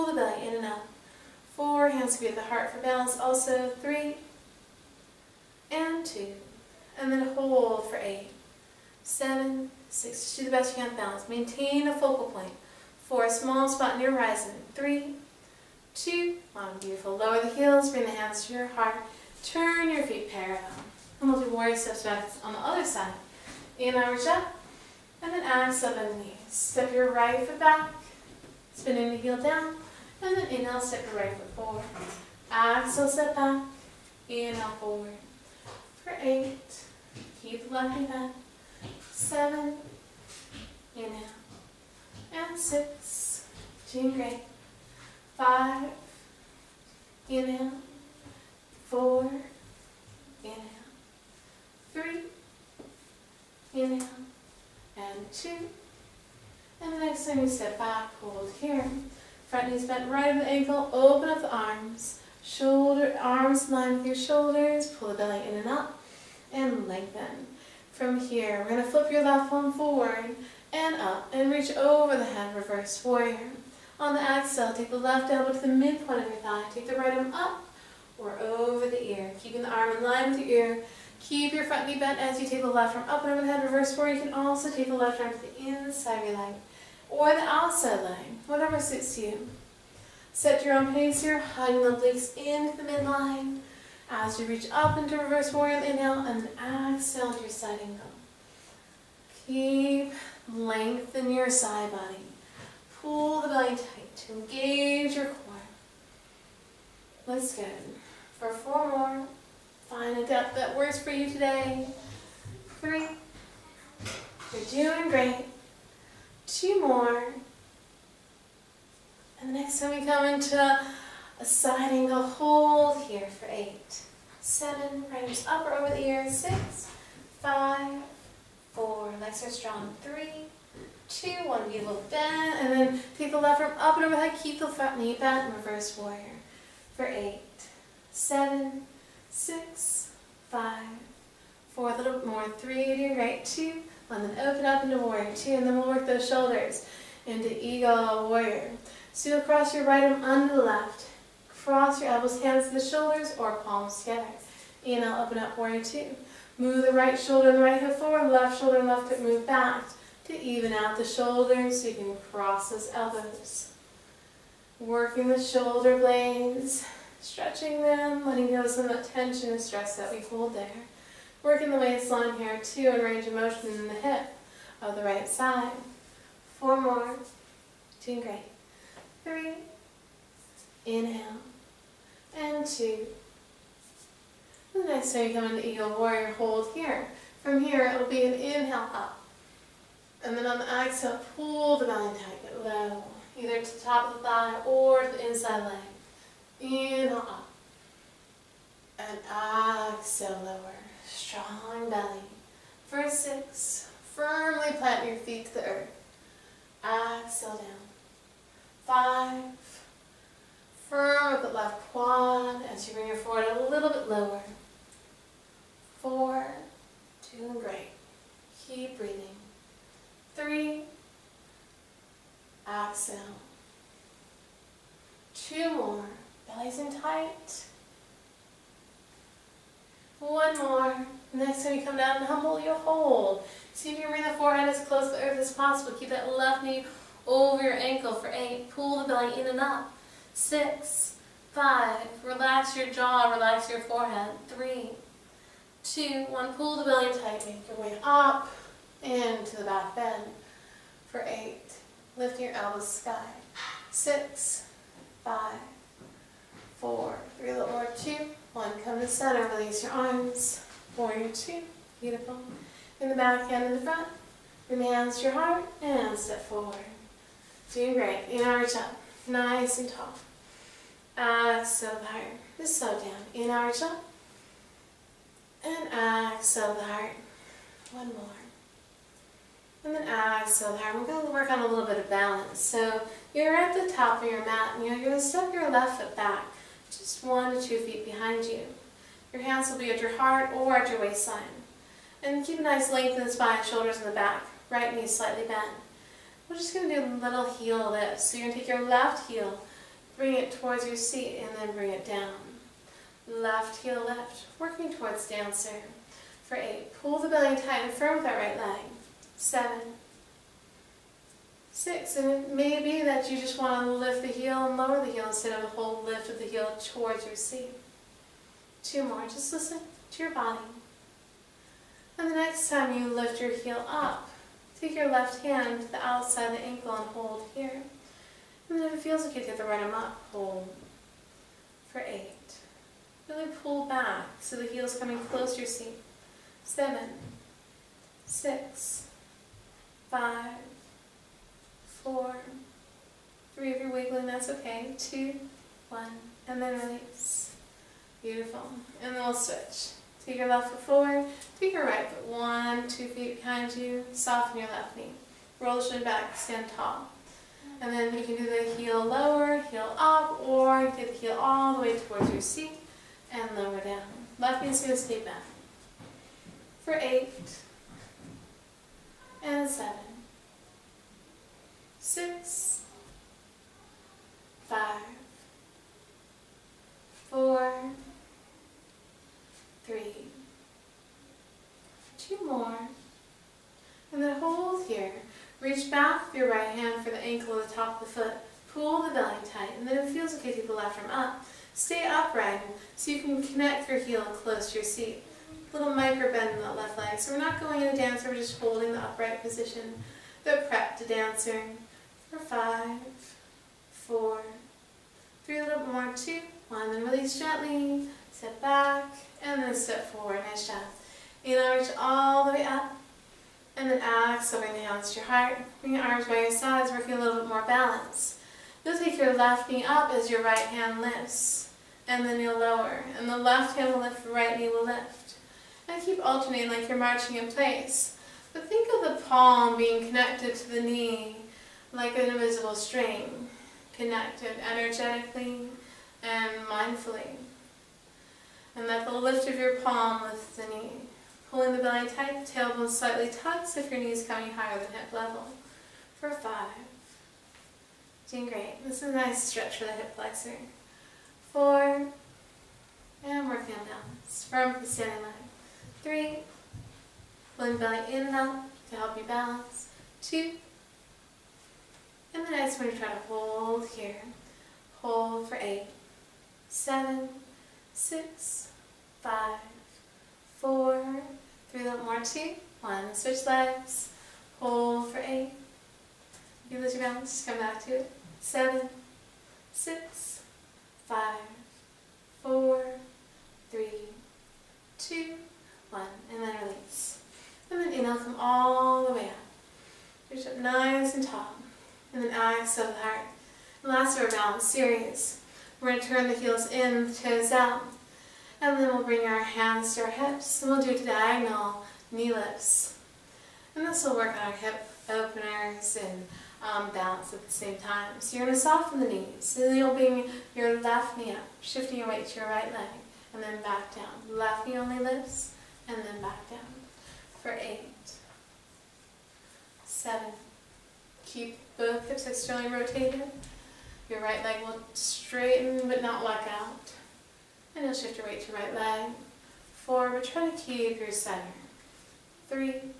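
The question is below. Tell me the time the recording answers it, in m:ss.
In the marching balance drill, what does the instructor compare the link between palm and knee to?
7:12.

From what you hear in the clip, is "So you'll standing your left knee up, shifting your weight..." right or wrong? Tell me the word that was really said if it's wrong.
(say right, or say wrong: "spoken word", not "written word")
wrong: "bring", not "standing".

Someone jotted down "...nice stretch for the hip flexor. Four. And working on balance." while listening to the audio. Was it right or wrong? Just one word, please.
right.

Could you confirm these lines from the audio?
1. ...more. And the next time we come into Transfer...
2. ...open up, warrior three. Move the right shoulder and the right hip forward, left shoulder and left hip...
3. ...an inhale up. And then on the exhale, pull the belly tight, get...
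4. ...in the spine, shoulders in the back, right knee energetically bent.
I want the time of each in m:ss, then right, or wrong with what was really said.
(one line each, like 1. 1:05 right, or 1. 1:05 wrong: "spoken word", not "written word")
1. 1:56 wrong: "Assigning", not "Transfer"
2. 2:35 wrong: "two", not "three"
3. 3:08 right
4. 4:53 wrong: "slightly", not "energetically".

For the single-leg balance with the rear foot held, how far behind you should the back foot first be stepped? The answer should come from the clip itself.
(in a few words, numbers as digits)
1 to 2 feet.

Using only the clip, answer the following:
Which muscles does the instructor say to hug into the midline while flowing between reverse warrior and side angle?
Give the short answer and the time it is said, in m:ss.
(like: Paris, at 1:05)
Obliques, at 1:31.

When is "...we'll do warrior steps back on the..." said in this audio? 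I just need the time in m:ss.
0:21.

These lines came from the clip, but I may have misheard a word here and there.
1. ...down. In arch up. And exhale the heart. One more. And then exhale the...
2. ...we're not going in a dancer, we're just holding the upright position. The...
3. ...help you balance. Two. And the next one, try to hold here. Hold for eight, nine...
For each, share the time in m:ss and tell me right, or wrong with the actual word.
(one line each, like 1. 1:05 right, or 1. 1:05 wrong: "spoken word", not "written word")
1. 4:32 right
2. 6:37 right
3. 7:38 wrong: "seven", not "nine".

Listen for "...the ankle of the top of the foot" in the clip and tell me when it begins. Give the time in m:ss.
6:27.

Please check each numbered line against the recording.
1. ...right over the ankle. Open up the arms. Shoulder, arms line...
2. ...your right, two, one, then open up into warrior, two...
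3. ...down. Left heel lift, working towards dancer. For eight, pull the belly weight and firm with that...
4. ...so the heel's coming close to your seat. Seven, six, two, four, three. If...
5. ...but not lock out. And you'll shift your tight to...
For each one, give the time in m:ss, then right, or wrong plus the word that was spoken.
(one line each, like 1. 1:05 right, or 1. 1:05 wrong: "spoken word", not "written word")
1. 1:00 right
2. 2:22 right
3. 5:02 wrong: "tight", not "weight"
4. 5:34 wrong: "five", not "two"
5. 8:45 wrong: "weight", not "tight".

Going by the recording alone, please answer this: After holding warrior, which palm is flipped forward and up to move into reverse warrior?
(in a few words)
Left palm.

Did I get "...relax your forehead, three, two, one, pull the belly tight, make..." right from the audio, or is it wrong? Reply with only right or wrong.
right.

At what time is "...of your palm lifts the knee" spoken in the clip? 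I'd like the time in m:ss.
7:19.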